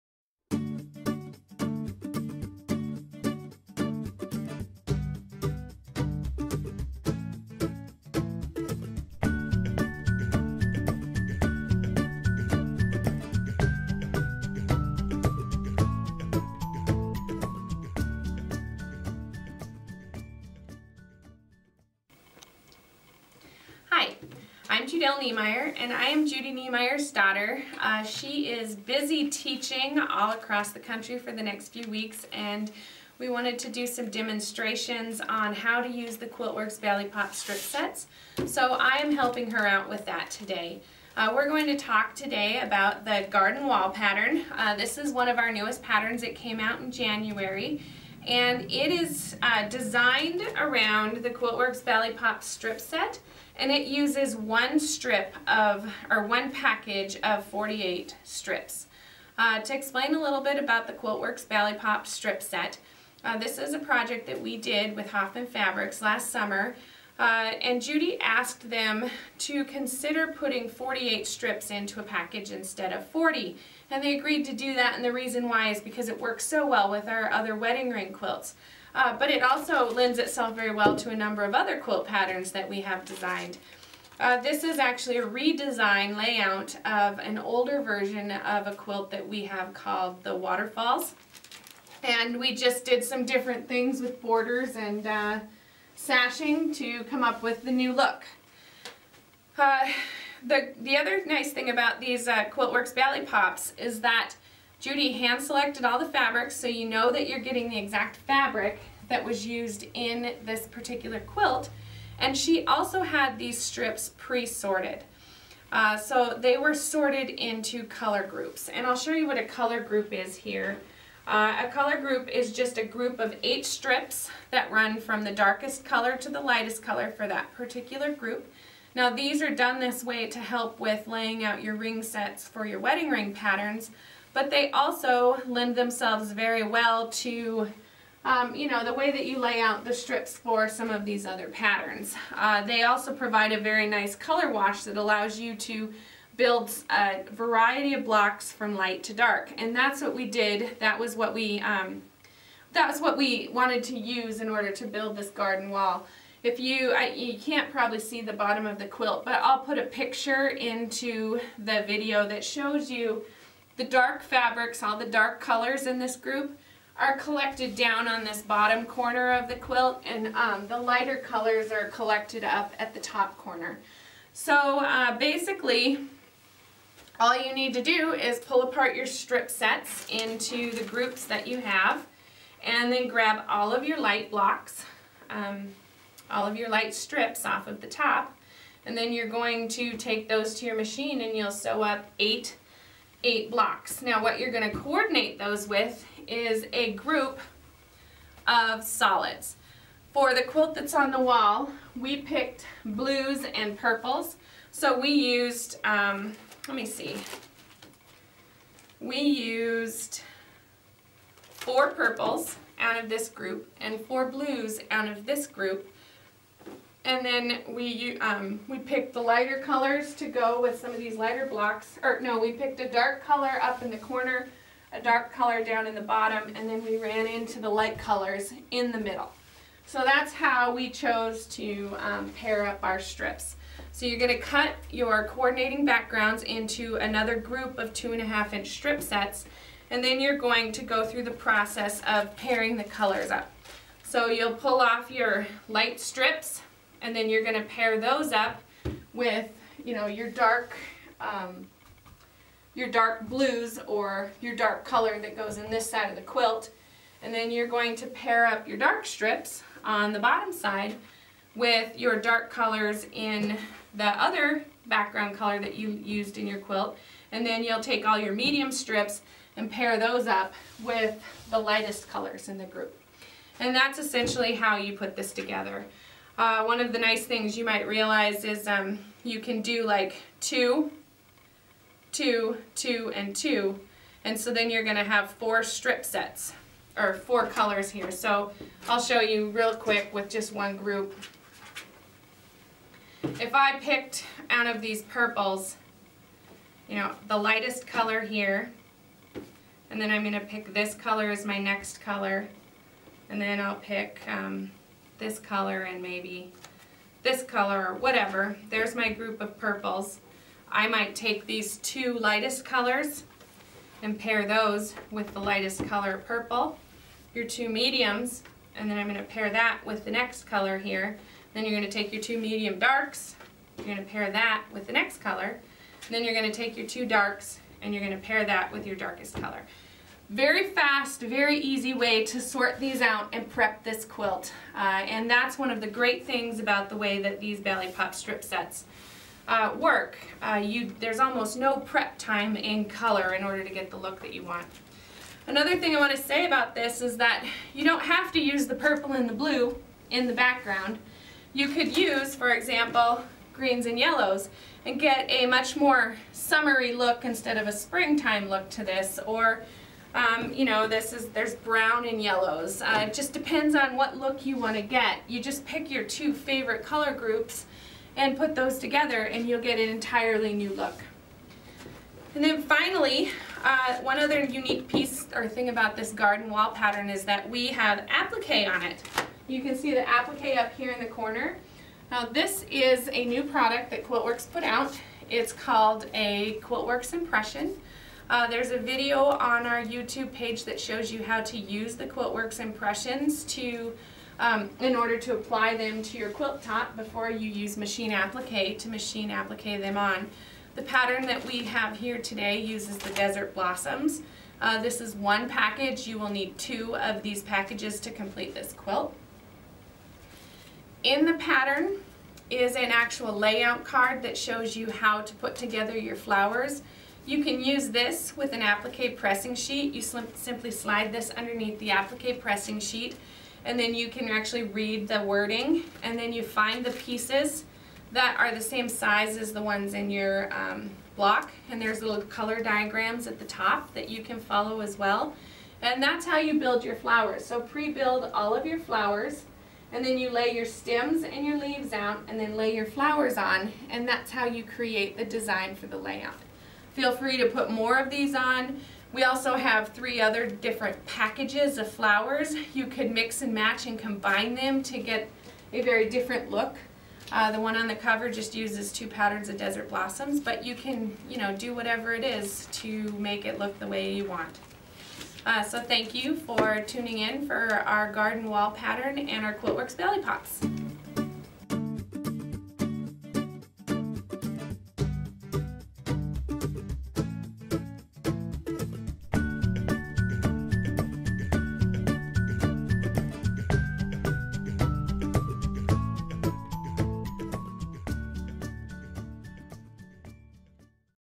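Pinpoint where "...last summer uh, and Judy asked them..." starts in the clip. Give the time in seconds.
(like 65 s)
66 s.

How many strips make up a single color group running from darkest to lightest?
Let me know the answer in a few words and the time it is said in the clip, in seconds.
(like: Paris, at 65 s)
8, at 123 s.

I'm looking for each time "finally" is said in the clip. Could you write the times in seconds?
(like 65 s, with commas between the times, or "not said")
372 s.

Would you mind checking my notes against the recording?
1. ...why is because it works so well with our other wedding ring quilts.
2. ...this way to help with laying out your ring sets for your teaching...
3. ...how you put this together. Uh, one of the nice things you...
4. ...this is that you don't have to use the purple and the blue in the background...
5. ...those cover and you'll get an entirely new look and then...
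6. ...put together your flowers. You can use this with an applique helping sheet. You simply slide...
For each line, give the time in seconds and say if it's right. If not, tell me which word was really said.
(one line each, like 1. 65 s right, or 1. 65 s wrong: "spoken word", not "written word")
1. 75 s right
2. 129 s wrong: "wedding", not "teaching"
3. 274 s right
4. 346 s right
5. 368 s wrong: "together", not "cover"
6. 415 s wrong: "pressing", not "helping".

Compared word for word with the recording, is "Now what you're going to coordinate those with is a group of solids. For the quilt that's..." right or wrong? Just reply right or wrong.
right.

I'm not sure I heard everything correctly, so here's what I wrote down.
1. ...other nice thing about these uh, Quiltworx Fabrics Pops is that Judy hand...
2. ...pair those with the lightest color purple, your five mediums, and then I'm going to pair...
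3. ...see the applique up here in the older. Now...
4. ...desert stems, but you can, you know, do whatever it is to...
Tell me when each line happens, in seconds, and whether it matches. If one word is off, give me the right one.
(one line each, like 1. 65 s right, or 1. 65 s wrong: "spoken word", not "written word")
1. 100 s wrong: "Bali", not "Fabrics"
2. 314 s wrong: "two", not "five"
3. 379 s wrong: "corner", not "older"
4. 459 s wrong: "blossoms", not "stems".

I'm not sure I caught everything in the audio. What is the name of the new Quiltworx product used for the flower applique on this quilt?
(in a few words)
Quiltworx Impression.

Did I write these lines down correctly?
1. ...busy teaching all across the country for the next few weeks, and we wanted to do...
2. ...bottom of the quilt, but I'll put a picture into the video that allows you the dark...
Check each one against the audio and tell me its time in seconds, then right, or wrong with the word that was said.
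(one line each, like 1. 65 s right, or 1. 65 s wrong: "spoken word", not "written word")
1. 28 s right
2. 158 s wrong: "shows", not "allows".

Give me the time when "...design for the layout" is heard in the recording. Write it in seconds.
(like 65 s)
445 s.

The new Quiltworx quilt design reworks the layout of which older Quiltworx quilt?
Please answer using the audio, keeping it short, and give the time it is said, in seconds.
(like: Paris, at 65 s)
Waterfalls, at 90 s.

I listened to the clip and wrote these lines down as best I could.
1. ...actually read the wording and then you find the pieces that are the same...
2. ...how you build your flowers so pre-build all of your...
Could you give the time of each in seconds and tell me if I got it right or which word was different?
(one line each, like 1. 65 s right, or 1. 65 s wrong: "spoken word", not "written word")
1. 424 s right
2. 436 s right.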